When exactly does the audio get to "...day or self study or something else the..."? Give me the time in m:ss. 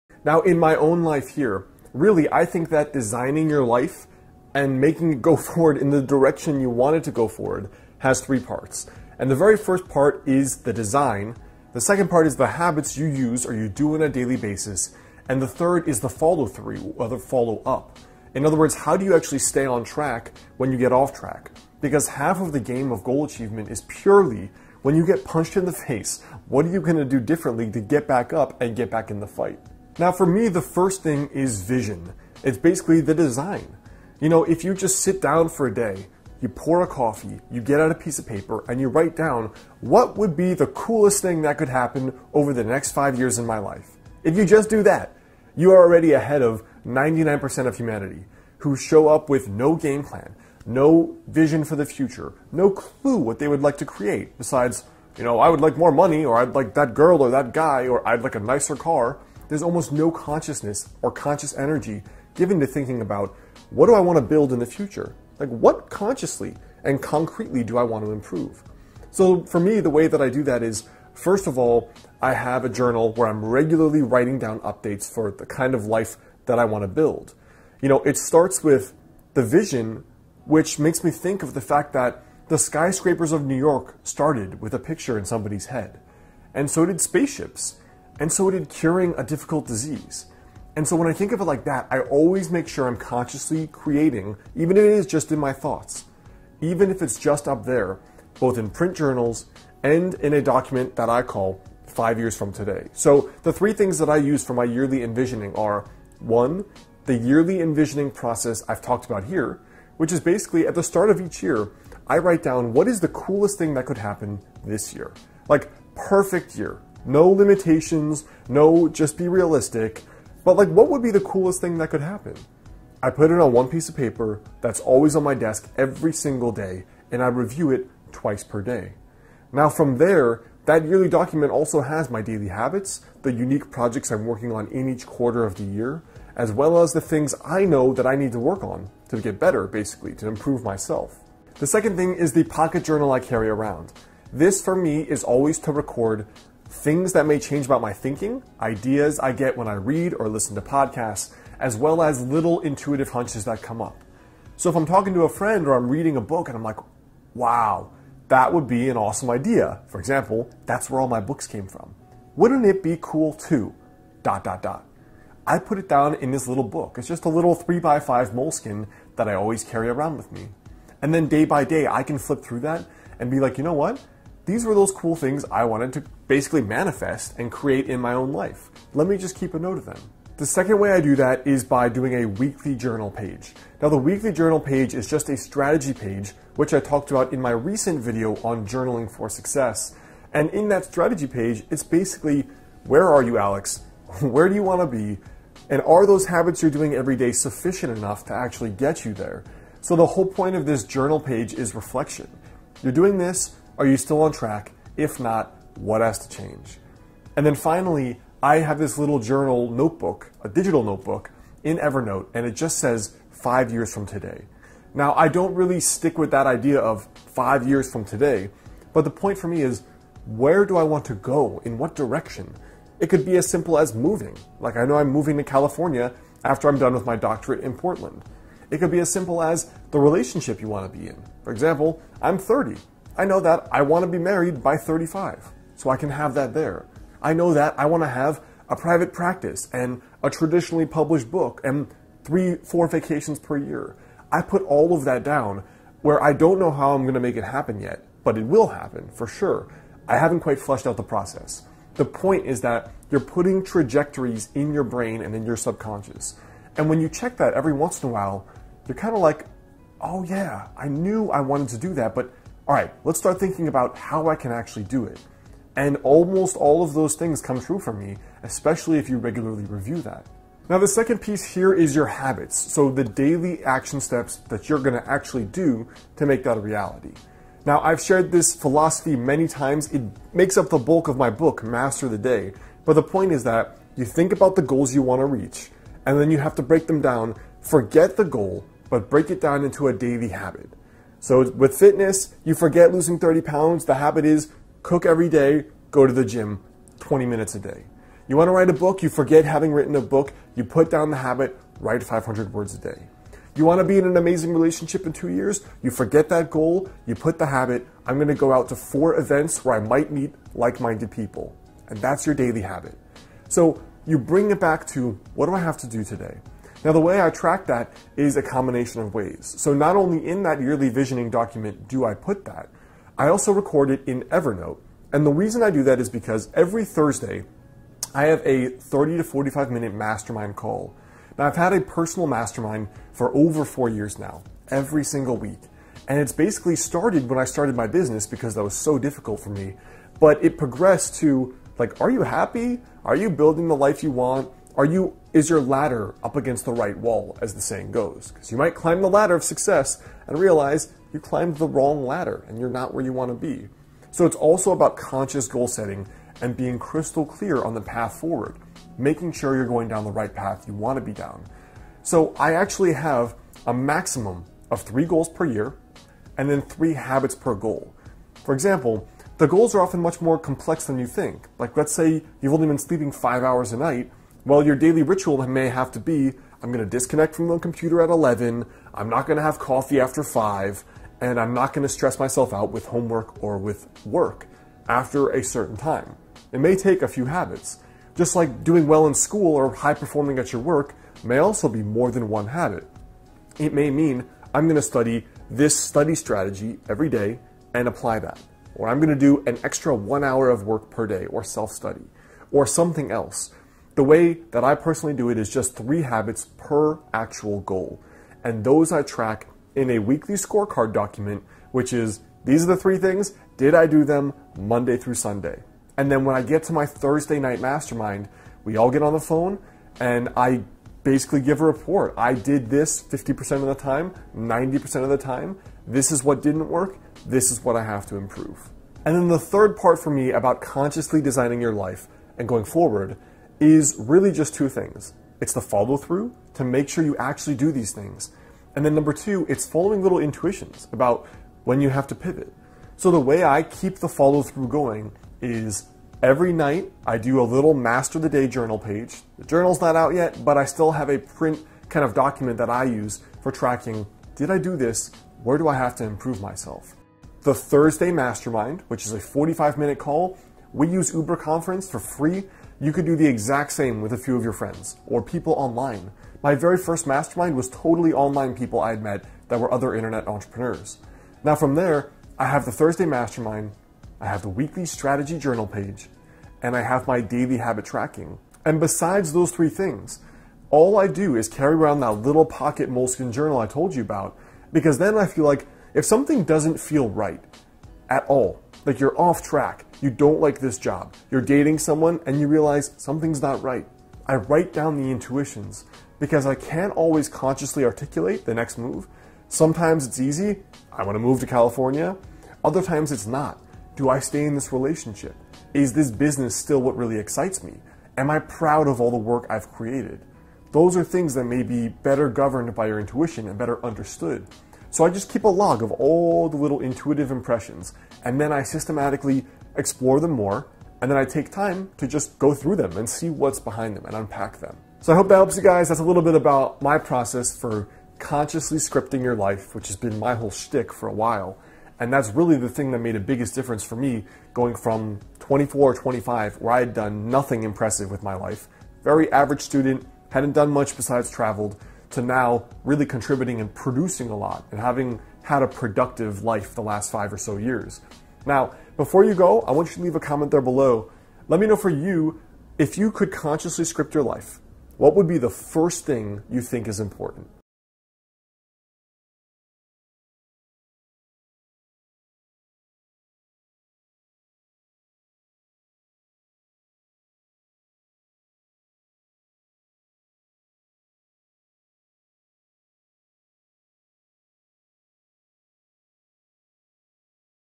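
6:41.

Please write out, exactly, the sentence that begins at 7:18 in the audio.
And then number two, it's following little intuitions about when you have to pivot.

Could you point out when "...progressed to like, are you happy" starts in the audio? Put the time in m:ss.
5:40.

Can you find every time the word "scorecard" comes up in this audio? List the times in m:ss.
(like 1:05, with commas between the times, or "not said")
6:50.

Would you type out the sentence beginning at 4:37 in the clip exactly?
Now, I've shared this philosophy many times.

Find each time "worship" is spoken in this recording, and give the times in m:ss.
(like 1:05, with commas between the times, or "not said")
not said.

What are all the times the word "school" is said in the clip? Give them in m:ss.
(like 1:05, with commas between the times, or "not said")
6:29.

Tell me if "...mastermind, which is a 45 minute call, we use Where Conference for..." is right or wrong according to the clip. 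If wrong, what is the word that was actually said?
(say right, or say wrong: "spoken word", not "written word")
wrong: "Uber", not "Where".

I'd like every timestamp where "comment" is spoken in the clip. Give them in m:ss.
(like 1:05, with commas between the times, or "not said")
9:10.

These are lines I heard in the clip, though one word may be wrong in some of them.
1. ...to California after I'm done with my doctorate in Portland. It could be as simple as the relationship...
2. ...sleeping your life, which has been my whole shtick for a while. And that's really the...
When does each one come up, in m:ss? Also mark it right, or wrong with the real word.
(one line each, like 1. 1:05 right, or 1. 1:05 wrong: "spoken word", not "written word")
1. 3:45 right
2. 8:48 wrong: "scripting", not "sleeping".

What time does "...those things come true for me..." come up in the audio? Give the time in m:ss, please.
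4:26.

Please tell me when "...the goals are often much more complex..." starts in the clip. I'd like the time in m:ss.
6:09.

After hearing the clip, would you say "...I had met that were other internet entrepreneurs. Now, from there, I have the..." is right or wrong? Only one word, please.
right.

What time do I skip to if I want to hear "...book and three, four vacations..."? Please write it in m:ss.
4:01.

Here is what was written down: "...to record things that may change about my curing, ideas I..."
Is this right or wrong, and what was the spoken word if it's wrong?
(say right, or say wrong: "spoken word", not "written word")
wrong: "thinking", not "curing".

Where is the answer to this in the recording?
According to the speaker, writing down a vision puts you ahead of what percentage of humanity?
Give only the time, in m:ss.
0:46.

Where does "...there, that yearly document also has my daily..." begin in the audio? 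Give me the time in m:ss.
2:09.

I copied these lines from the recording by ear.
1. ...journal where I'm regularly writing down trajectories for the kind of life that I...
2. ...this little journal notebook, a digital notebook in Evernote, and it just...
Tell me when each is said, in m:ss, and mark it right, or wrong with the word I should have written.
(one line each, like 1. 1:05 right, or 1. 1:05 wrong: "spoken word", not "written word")
1. 1:12 wrong: "updates", not "trajectories"
2. 3:28 right.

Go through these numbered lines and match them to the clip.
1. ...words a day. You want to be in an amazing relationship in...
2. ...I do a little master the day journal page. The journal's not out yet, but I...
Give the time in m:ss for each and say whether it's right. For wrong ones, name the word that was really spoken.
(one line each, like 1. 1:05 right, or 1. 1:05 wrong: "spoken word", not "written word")
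1. 5:02 right
2. 7:27 right.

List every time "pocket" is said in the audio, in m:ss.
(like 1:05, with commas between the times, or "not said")
2:22, 8:02.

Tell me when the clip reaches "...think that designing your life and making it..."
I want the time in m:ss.
0:02.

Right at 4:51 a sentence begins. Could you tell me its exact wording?
So with fitness, you forget losing 30 pounds.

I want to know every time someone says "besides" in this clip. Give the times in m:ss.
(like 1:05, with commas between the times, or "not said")
0:54, 7:58, 9:00.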